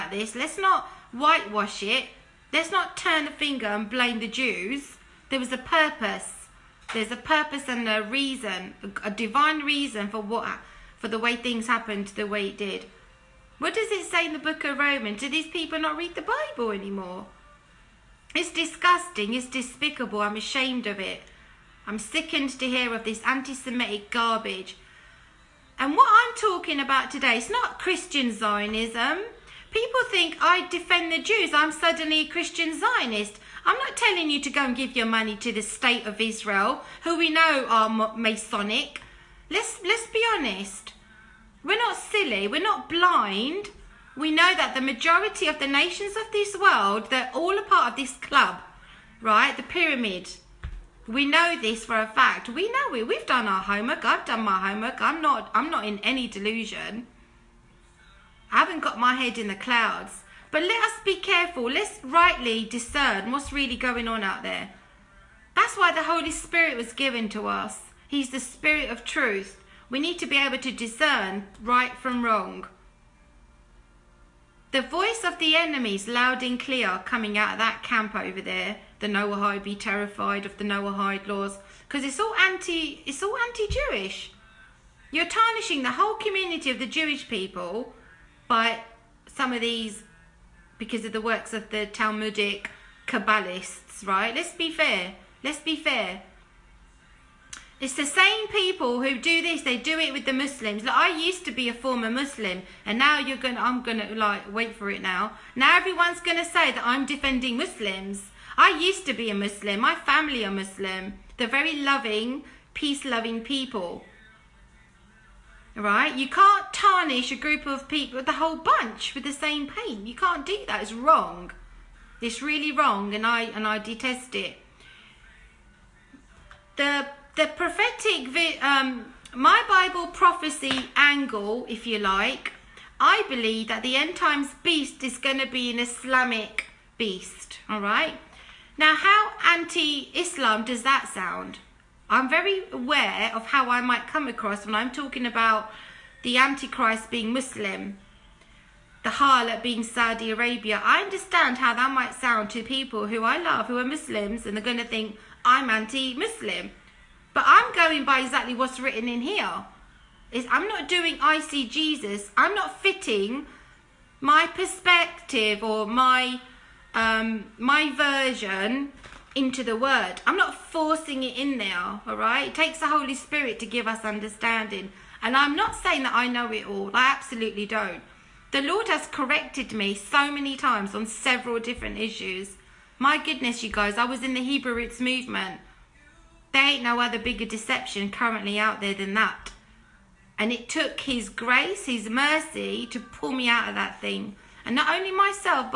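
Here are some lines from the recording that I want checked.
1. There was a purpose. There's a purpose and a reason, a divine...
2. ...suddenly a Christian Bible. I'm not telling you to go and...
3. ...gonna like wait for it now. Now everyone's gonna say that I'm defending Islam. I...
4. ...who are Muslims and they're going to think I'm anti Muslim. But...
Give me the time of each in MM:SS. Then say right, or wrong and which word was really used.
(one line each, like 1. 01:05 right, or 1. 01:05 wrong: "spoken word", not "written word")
1. 00:05 right
2. 00:31 wrong: "Zionist", not "Bible"
3. 01:43 wrong: "Muslims", not "Islam"
4. 02:33 right.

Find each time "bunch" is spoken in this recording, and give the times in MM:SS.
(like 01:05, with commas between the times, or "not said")
01:58.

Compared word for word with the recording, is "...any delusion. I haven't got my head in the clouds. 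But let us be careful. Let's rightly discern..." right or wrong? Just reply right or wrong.
right.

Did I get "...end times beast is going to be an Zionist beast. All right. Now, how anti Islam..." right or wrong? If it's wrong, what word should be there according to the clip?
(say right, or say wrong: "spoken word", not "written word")
wrong: "Islamic", not "Zionist".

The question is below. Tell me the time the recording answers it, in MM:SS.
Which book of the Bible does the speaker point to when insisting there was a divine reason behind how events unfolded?
00:14.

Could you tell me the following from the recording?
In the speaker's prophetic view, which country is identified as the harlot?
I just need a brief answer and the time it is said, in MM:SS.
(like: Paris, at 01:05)
Saudi Arabia, at 02:29.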